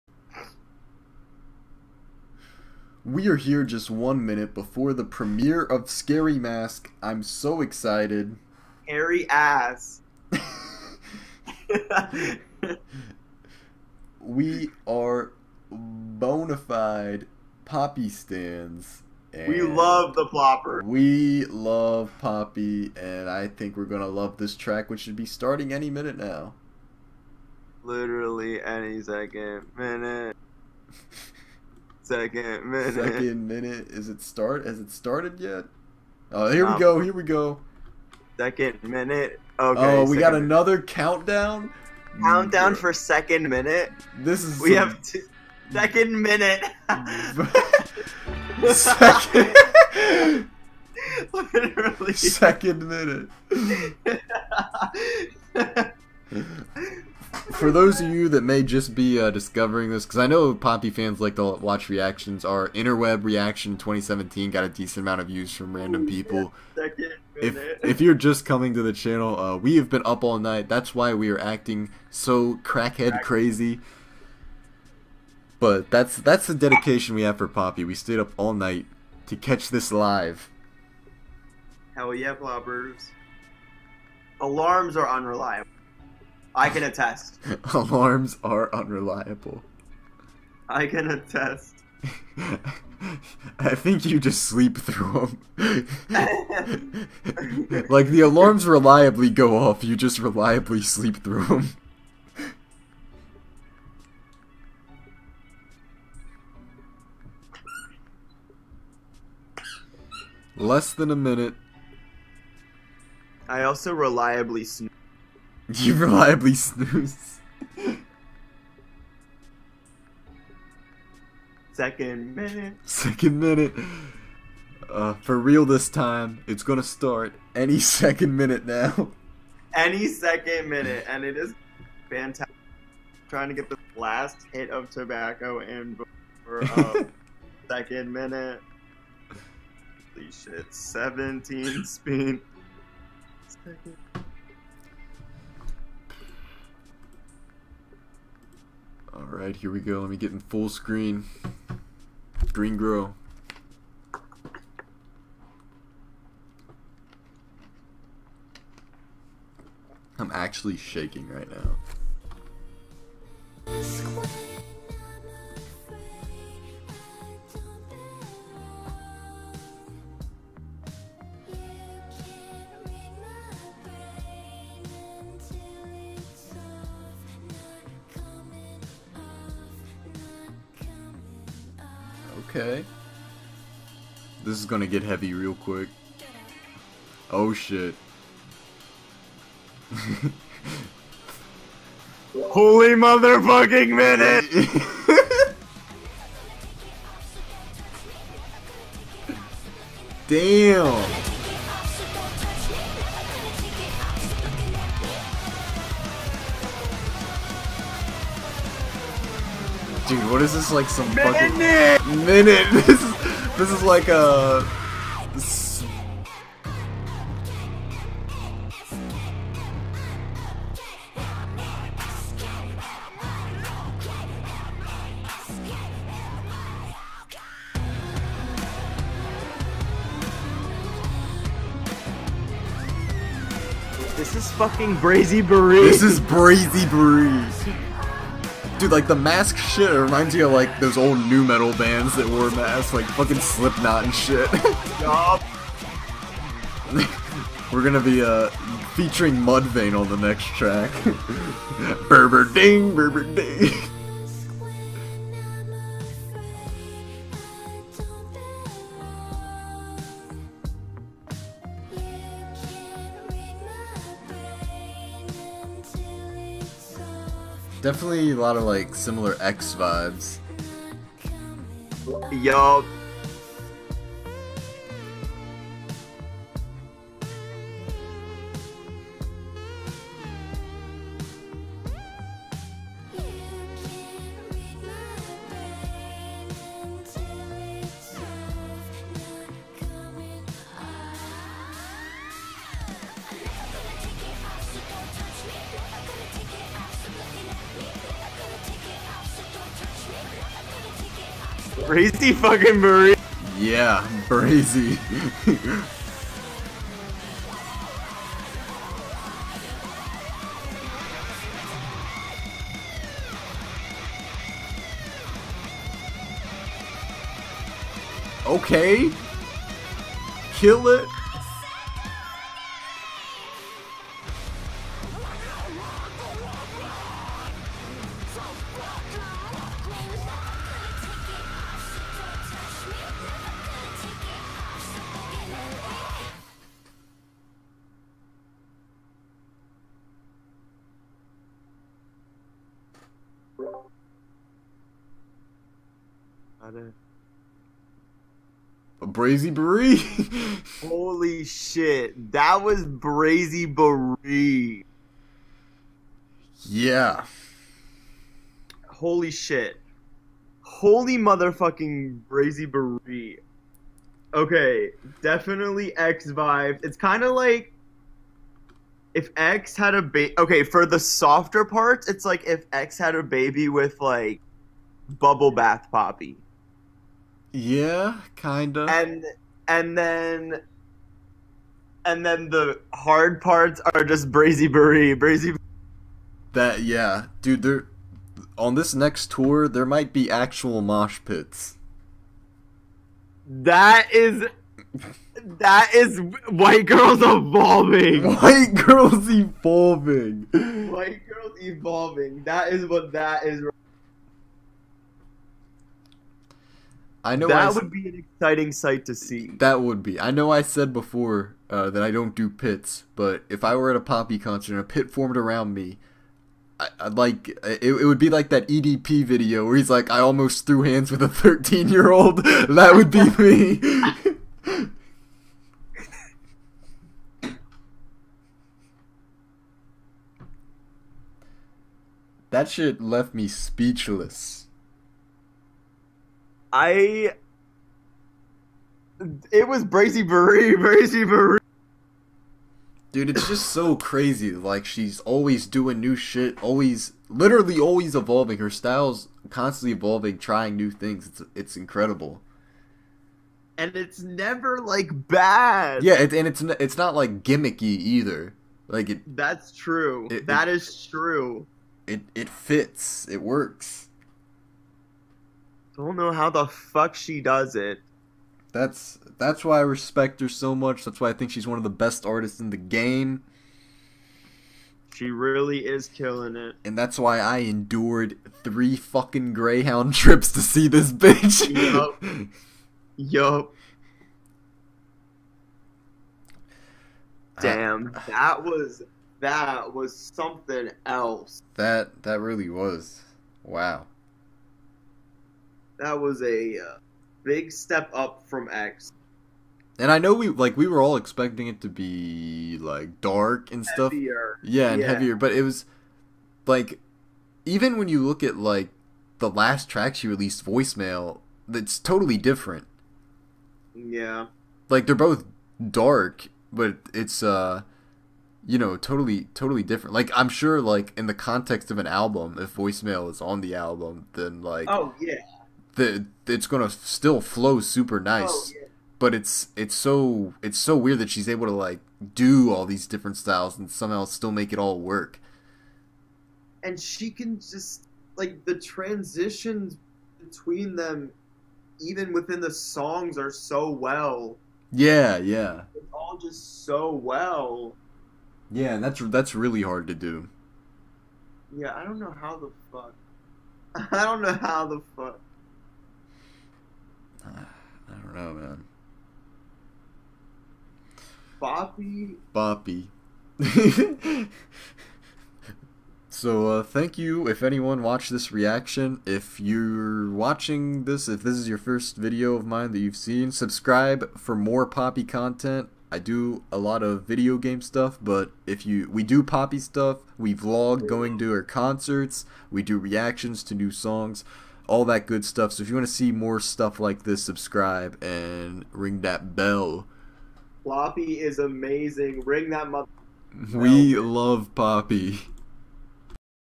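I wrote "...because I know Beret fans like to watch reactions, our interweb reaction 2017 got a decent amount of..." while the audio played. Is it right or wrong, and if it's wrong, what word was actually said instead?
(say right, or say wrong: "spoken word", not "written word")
wrong: "Poppy", not "Beret".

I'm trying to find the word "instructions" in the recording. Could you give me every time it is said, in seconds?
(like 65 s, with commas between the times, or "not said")
not said.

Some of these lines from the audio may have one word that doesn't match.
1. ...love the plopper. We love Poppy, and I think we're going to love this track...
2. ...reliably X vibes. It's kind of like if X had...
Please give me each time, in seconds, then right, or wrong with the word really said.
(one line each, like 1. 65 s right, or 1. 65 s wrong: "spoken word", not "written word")
1. 19 s right
2. 365 s wrong: "definitely", not "reliably".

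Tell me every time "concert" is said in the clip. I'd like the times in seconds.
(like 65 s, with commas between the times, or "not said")
414 s, 581 s.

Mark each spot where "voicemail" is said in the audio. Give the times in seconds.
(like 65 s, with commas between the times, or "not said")
510 s, 522 s.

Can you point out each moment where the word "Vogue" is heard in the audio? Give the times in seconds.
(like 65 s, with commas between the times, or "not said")
not said.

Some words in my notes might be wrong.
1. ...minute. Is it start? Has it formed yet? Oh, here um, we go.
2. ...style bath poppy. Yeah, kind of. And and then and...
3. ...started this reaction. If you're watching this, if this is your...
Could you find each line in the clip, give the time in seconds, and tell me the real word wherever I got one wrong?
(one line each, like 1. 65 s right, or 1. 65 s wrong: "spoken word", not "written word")
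1. 33 s wrong: "started", not "formed"
2. 375 s wrong: "bubble", not "style"
3. 568 s wrong: "watched", not "started".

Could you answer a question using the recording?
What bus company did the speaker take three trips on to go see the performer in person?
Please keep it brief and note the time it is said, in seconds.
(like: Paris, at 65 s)
Greyhound, at 479 s.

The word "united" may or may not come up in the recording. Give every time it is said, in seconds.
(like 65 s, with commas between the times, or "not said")
not said.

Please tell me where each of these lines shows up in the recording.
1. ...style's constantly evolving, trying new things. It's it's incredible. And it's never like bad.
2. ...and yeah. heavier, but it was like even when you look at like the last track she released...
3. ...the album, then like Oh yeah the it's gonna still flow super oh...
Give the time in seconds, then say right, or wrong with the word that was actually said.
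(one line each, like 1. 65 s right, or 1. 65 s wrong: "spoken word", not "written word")
1. 448 s right
2. 504 s right
3. 523 s right.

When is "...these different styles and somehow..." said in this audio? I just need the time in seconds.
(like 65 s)
532 s.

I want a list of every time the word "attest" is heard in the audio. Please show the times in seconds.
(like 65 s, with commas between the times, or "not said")
86 s, 91 s.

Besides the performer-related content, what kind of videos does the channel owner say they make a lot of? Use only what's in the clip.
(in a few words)
Video game stuff.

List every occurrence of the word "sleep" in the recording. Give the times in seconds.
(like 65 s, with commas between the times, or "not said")
94 s, 100 s.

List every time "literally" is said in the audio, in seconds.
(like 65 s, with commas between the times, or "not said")
27 s, 51 s, 447 s.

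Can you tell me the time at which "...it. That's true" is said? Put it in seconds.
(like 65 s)
459 s.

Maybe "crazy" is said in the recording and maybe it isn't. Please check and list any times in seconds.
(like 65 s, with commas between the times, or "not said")
73 s, 443 s.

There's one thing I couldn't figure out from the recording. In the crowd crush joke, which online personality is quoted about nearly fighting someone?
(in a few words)
EDP.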